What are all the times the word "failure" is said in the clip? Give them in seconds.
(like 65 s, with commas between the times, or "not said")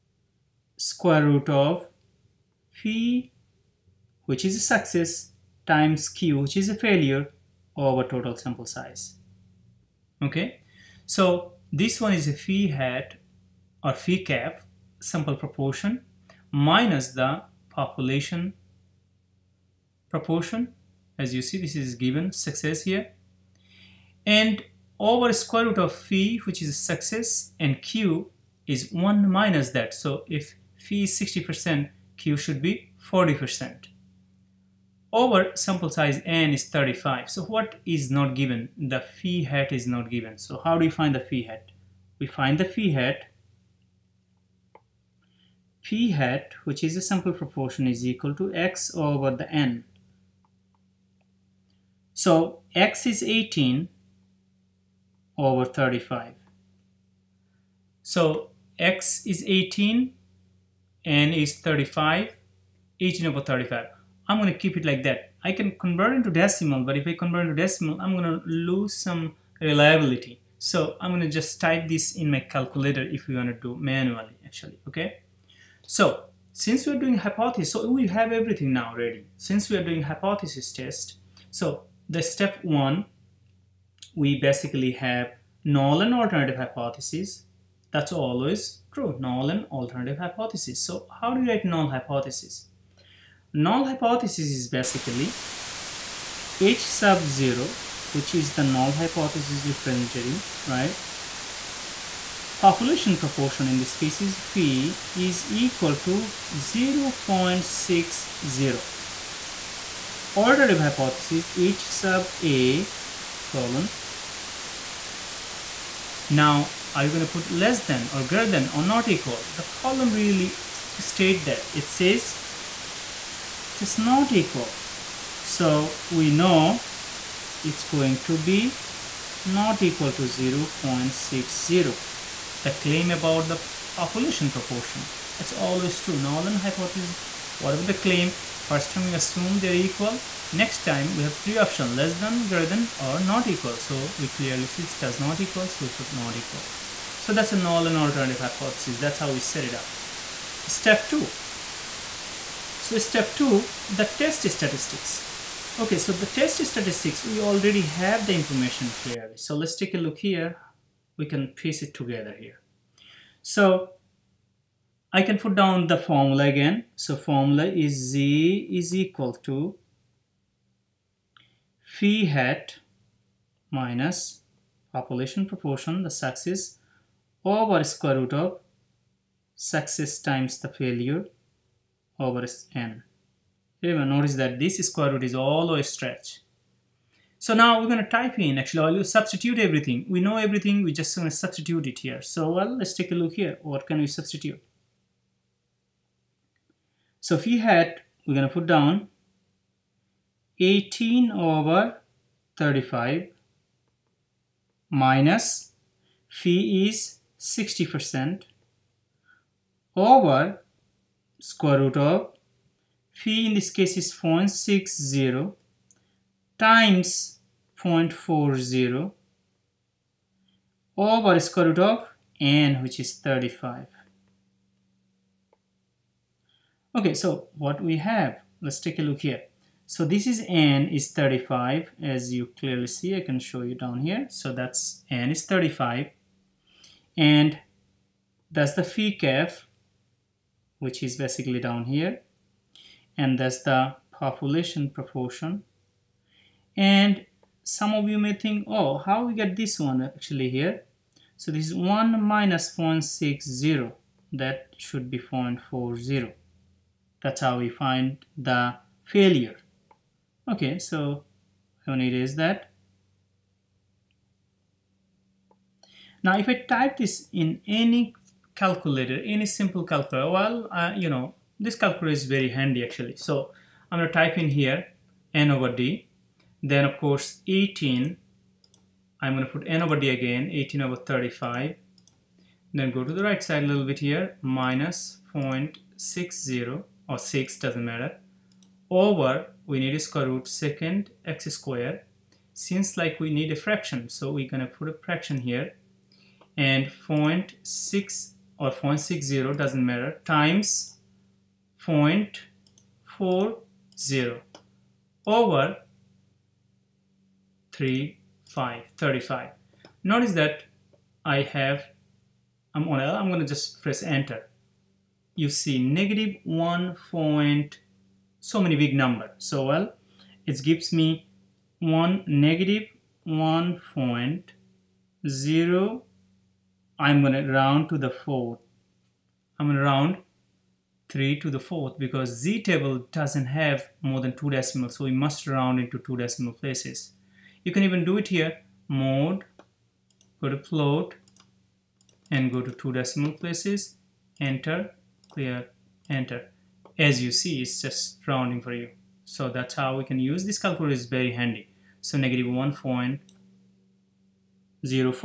6 s, 180 s, 259 s.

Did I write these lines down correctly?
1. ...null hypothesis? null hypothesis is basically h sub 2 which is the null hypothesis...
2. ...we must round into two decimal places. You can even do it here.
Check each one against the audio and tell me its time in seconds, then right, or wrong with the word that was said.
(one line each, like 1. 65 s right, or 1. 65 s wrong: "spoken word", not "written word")
1. 91 s wrong: "0", not "2"
2. 335 s right.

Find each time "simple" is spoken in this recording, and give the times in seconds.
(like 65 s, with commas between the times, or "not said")
269 s.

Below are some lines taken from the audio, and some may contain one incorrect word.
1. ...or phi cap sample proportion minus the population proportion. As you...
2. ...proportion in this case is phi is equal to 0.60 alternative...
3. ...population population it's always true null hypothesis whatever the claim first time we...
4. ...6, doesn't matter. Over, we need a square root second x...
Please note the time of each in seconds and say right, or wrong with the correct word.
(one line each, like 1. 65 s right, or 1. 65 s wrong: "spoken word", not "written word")
1. 13 s right
2. 103 s right
3. 133 s wrong: "proportion", not "population"
4. 287 s right.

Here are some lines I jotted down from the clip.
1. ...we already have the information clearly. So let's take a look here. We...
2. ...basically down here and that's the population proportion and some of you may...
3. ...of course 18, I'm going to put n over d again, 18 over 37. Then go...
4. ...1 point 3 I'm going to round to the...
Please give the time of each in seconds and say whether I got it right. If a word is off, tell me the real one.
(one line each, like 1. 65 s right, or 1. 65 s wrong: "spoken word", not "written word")
1. 157 s right
2. 241 s right
3. 276 s wrong: "35", not "37"
4. 323 s wrong: "0", not "3".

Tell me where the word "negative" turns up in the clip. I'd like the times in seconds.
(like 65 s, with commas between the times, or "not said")
315 s, 322 s.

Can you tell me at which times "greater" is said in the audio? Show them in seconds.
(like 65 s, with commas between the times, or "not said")
118 s, 142 s.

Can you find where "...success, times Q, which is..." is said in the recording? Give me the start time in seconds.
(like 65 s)
4 s.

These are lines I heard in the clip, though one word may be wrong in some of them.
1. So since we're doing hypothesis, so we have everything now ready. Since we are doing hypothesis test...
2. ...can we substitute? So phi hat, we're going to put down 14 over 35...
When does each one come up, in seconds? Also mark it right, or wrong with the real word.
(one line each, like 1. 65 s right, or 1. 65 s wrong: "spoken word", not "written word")
1. 75 s right
2. 193 s wrong: "18", not "14".